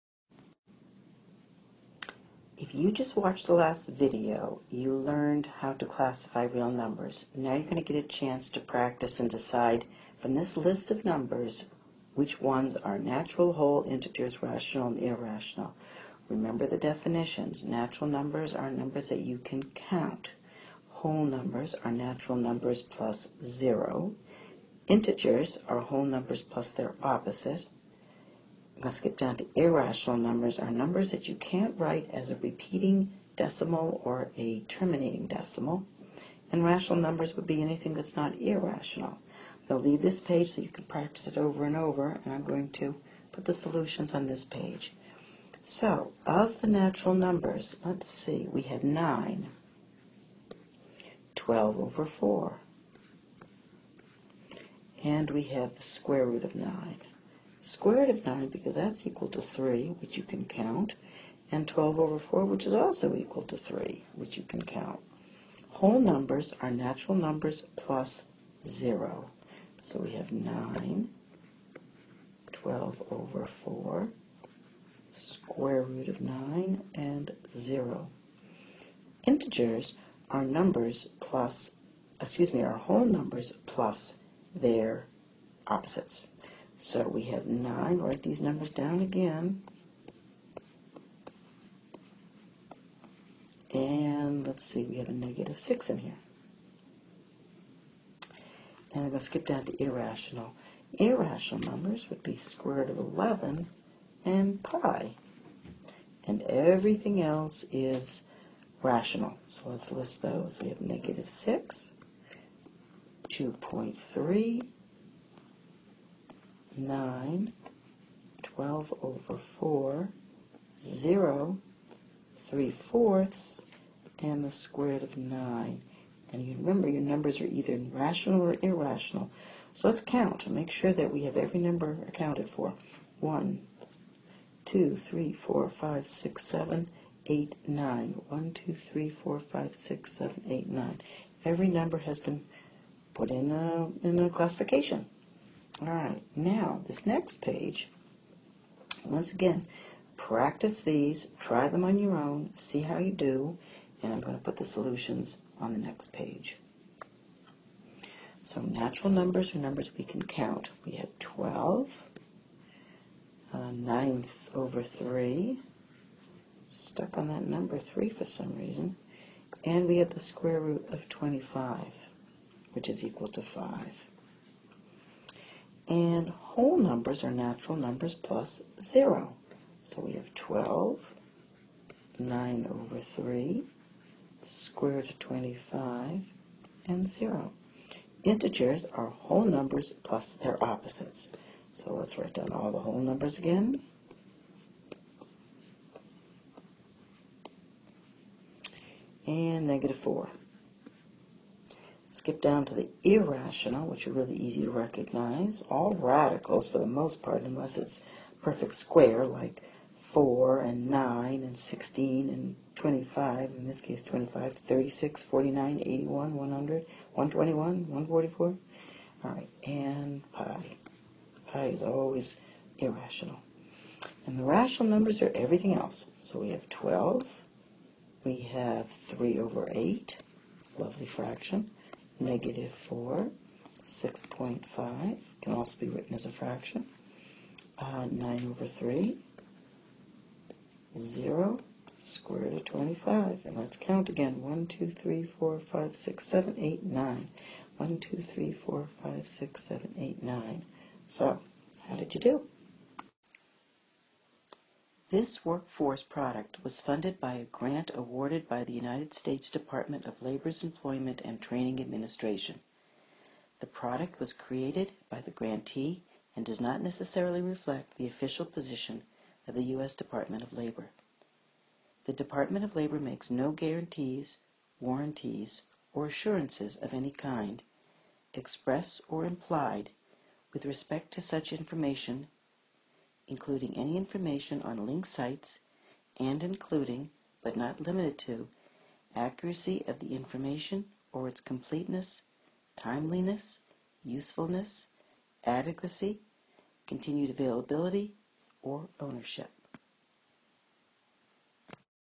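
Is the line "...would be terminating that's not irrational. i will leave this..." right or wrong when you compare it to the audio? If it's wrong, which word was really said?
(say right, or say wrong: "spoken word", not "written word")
wrong: "anything", not "terminating".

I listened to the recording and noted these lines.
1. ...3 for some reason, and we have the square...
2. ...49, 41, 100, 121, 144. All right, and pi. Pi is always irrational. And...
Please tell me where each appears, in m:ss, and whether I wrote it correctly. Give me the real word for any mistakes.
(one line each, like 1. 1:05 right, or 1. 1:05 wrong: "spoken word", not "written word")
1. 2:47 right
2. 3:35 wrong: "81", not "41".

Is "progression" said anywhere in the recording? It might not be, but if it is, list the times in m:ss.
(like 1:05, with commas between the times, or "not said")
not said.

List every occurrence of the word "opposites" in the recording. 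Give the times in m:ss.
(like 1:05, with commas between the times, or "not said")
0:27, 1:25, 3:10.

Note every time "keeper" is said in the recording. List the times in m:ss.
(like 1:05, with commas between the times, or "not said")
not said.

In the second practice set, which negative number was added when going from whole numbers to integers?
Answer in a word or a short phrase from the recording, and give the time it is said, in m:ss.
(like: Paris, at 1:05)
-4, at 3:19.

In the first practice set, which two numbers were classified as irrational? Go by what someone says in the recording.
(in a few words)
square root of 11 and pi.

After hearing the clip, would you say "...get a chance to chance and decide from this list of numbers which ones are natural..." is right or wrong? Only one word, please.
wrong.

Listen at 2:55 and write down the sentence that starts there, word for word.
And whole numbers are natural numbers plus 0.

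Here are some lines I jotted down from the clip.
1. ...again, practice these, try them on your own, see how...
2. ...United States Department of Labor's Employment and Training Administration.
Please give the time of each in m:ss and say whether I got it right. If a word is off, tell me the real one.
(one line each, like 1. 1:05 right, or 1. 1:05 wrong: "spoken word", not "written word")
1. 2:29 right
2. 4:18 right.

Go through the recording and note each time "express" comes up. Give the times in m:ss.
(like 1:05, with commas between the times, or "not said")
4:38.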